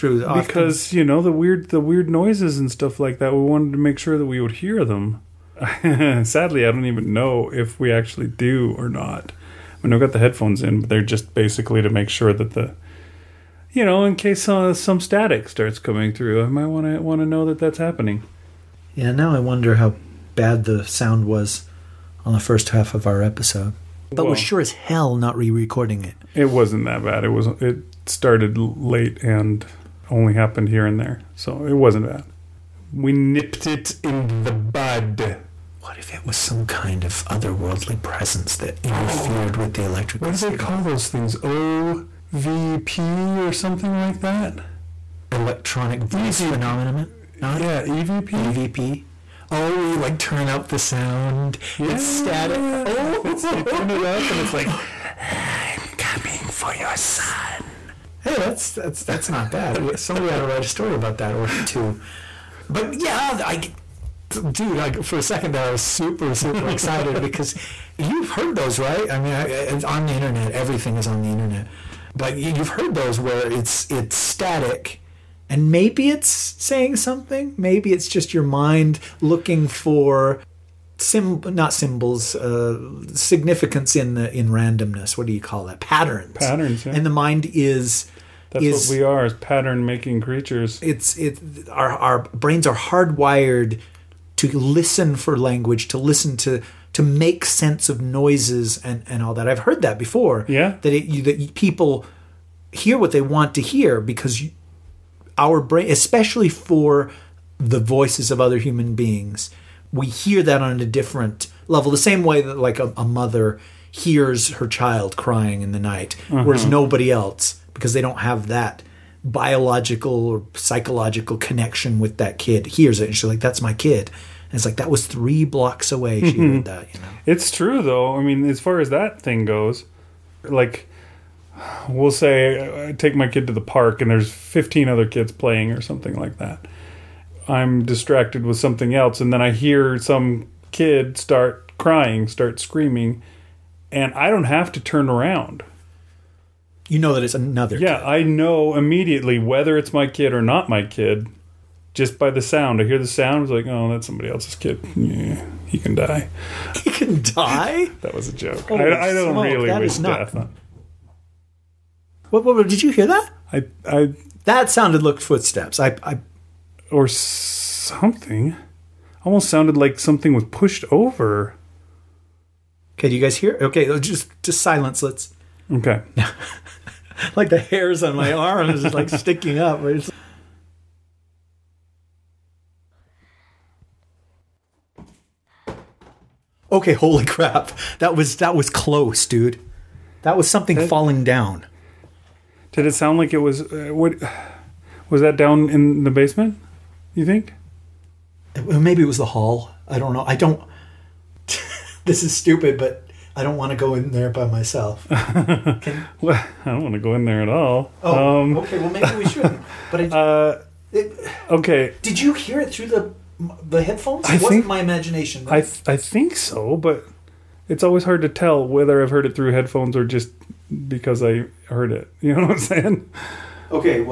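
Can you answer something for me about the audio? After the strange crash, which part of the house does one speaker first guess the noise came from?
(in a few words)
The basement.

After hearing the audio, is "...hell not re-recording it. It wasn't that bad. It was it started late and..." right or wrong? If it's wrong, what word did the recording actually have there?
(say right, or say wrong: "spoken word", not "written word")
right.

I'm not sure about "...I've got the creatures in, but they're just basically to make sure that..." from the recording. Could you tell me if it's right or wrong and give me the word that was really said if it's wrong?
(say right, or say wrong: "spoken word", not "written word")
wrong: "headphones", not "creatures".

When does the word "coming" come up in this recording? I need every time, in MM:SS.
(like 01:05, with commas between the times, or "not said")
00:15, 00:55.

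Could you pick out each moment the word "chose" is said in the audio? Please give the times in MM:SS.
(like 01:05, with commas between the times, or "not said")
not said.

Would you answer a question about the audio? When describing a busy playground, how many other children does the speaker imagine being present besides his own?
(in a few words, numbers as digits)
15.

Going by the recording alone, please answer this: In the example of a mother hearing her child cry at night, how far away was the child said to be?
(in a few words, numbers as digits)
Three blocks.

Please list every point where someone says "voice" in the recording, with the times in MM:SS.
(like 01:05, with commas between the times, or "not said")
00:46, 01:47.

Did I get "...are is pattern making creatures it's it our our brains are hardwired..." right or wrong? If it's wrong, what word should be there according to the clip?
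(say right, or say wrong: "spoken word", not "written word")
right.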